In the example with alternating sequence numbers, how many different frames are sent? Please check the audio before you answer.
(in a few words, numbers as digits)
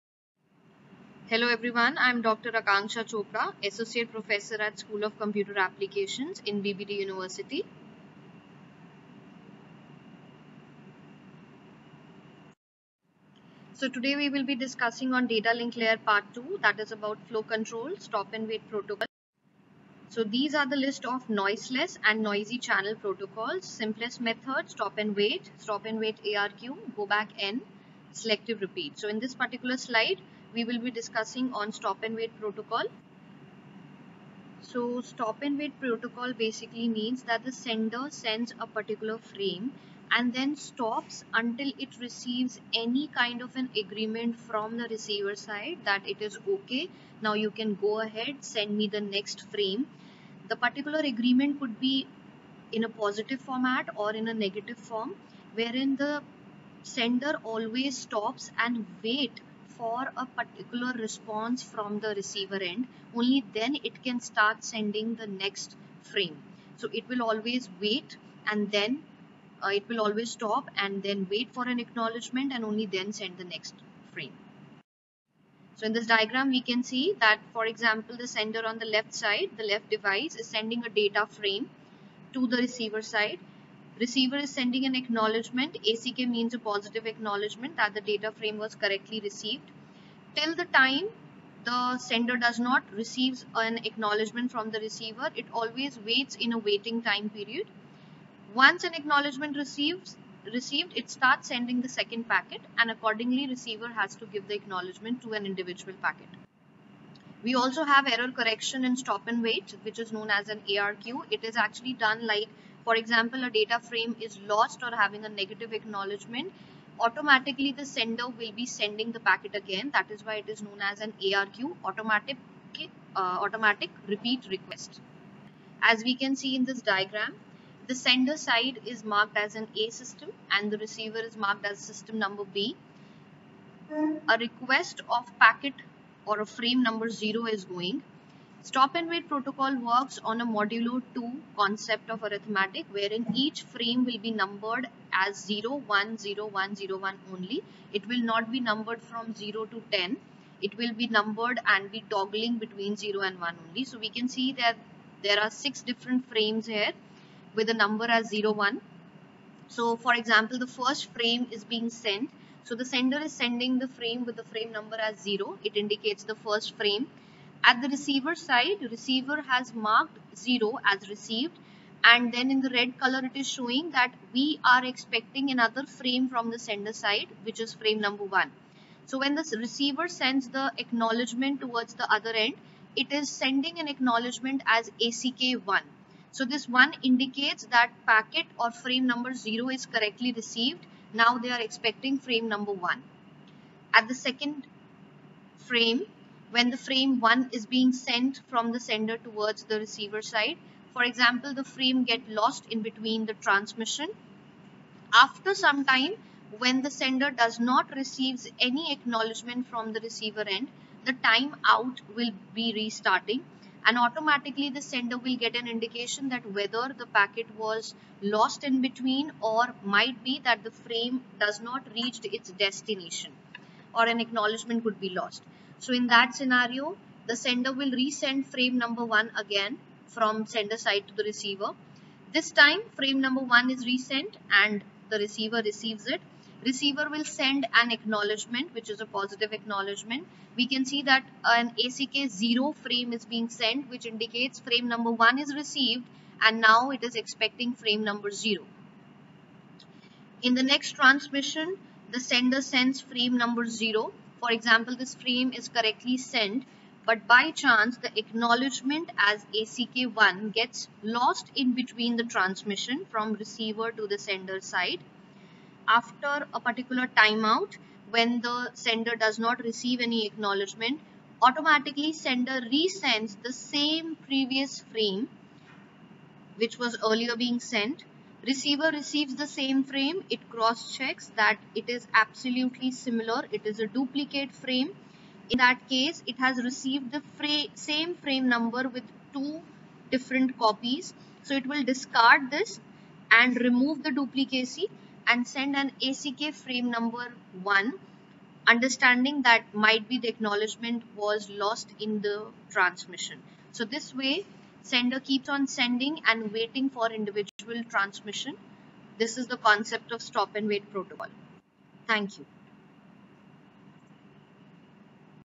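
6.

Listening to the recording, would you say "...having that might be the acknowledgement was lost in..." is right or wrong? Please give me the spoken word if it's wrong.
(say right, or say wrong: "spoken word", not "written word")
wrong: "understanding", not "having".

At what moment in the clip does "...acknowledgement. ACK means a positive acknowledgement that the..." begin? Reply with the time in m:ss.
1:24.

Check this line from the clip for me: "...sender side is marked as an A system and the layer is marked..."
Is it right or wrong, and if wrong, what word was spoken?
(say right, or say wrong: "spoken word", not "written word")
wrong: "receiver", not "layer".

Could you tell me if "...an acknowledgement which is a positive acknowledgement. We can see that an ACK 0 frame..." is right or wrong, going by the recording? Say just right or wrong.
right.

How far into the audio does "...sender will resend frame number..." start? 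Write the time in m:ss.
3:47.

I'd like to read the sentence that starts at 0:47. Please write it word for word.
Now you can go ahead, send me the next frame.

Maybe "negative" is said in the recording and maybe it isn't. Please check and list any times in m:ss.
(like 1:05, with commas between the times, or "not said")
0:54, 1:55.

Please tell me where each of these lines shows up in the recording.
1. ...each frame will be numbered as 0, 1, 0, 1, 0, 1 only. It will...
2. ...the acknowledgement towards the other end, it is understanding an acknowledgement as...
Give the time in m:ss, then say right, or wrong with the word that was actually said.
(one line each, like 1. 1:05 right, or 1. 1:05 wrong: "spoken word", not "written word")
1. 2:23 right
2. 3:00 wrong: "sending", not "understanding".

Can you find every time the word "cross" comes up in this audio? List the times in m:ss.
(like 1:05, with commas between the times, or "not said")
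4:40.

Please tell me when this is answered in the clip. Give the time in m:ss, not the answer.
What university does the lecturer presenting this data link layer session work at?
0:06.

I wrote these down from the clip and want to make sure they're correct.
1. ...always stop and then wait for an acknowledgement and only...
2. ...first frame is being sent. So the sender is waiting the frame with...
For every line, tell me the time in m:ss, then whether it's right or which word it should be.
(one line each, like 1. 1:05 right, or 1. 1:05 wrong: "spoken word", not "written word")
1. 1:10 right
2. 2:40 wrong: "sending", not "waiting".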